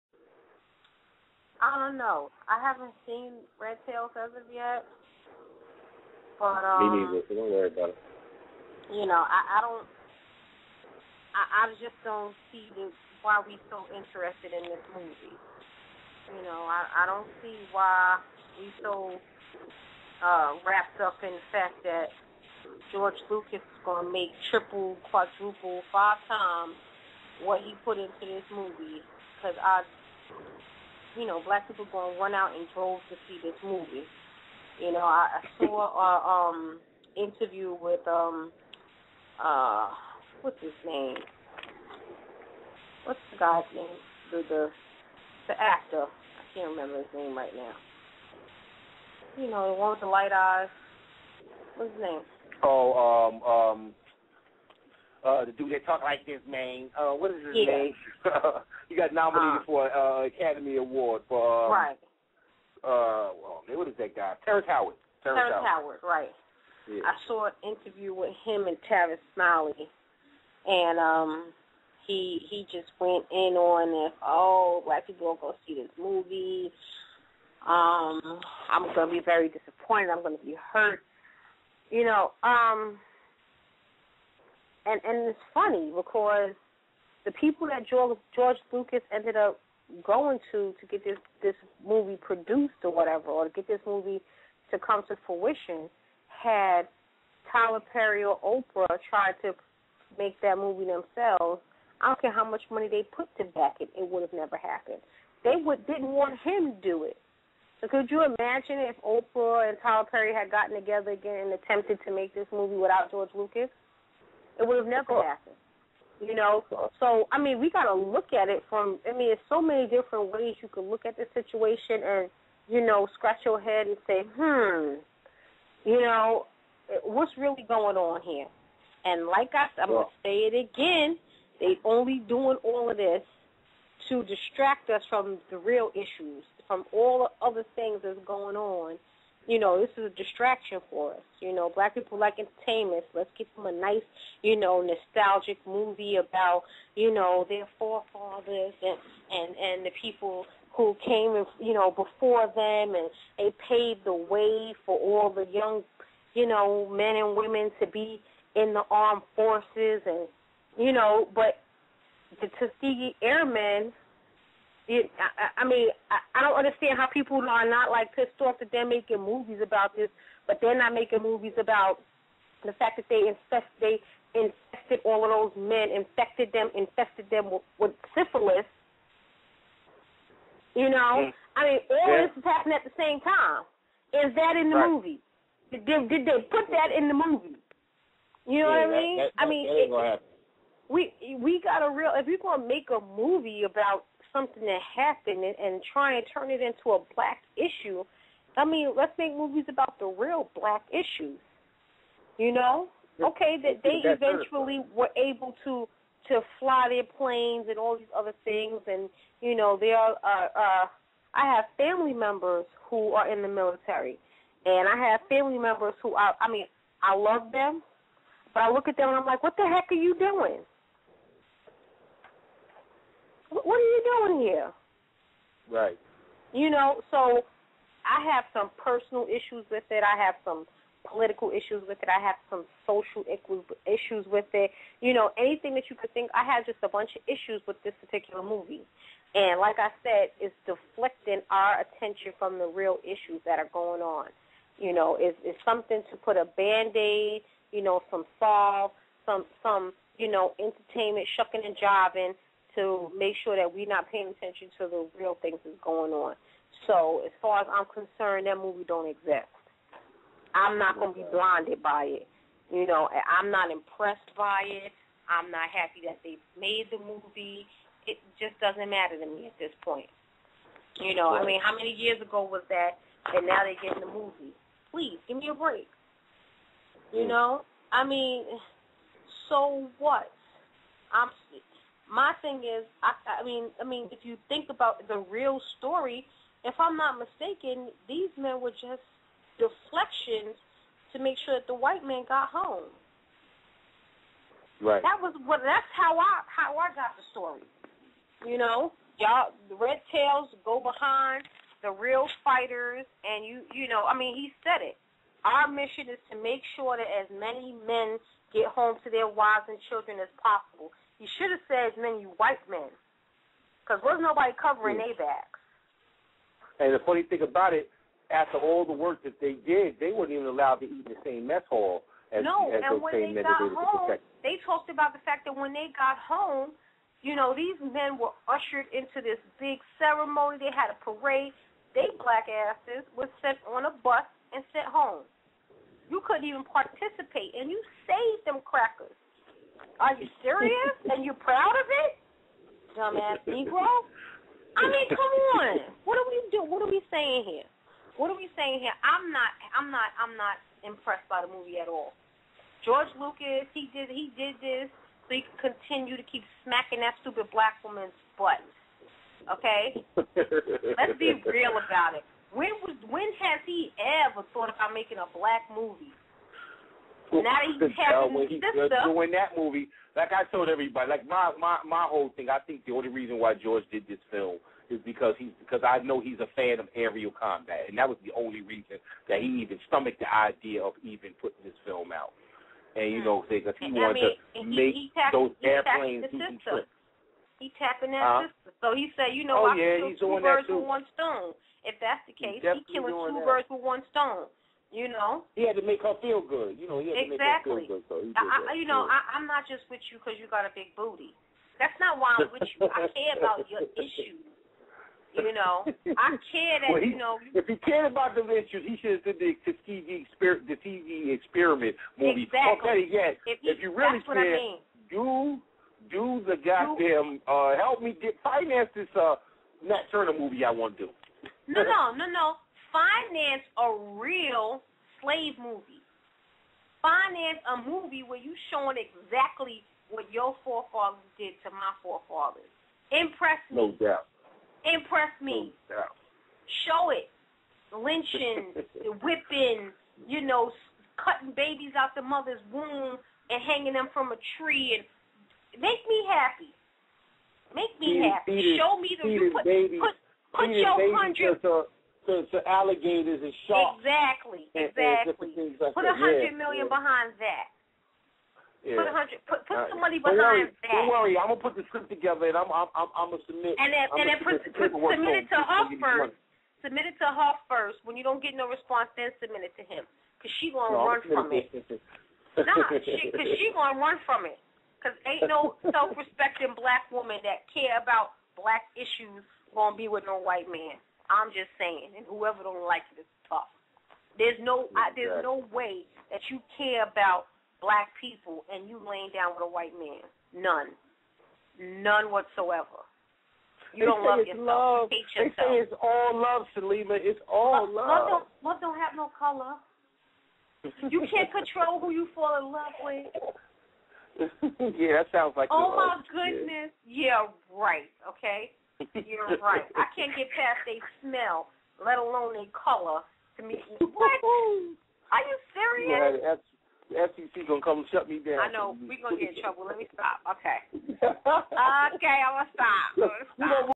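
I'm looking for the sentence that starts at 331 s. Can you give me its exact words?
They black asses were sent on a bus and sent home.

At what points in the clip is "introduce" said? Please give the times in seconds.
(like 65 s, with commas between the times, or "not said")
not said.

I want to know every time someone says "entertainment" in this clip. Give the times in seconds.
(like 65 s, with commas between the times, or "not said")
142 s, 250 s.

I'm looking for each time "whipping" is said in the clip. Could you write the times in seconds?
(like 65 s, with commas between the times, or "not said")
439 s.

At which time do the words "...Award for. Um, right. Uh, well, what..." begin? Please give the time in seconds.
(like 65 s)
60 s.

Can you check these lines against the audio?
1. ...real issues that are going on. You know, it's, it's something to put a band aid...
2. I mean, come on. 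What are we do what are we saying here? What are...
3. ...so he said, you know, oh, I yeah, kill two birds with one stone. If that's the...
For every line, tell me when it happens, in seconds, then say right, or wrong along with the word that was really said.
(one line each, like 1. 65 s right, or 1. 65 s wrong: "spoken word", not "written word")
1. 242 s right
2. 344 s right
3. 388 s right.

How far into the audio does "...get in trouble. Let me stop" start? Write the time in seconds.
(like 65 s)
519 s.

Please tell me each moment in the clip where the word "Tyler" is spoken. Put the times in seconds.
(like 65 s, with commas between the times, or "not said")
97 s, 109 s.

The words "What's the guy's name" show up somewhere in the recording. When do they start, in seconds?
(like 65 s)
43 s.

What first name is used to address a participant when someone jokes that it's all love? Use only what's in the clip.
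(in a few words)
Saleema.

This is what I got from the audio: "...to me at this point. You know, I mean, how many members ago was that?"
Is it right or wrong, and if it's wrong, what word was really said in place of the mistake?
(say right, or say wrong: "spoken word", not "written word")
wrong: "years", not "members".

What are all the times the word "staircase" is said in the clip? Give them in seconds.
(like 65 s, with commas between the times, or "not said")
not said.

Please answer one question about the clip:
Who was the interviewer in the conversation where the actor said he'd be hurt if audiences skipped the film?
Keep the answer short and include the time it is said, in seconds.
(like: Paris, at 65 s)
Tavis Smiley, at 68 s.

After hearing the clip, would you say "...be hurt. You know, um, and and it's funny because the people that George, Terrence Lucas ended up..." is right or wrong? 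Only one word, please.
wrong.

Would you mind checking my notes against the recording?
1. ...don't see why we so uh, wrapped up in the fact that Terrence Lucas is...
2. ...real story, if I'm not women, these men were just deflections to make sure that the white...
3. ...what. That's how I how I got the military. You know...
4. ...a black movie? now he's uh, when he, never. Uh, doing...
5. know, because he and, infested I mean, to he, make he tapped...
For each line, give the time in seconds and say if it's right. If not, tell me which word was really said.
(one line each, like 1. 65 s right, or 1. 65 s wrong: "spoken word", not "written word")
1. 17 s wrong: "George", not "Terrence"
2. 285 s wrong: "mistaken", not "women"
3. 295 s wrong: "story", not "military"
4. 365 s wrong: "sister", not "never"
5. 383 s wrong: "wanted", not "infested".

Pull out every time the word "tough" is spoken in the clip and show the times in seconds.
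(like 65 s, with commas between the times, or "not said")
483 s.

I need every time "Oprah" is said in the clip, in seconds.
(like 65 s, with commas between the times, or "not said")
98 s, 109 s.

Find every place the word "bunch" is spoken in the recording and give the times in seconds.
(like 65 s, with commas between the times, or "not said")
236 s.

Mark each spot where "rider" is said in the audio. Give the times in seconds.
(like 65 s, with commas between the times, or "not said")
not said.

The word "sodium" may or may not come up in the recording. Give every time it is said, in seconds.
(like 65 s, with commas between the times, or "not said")
not said.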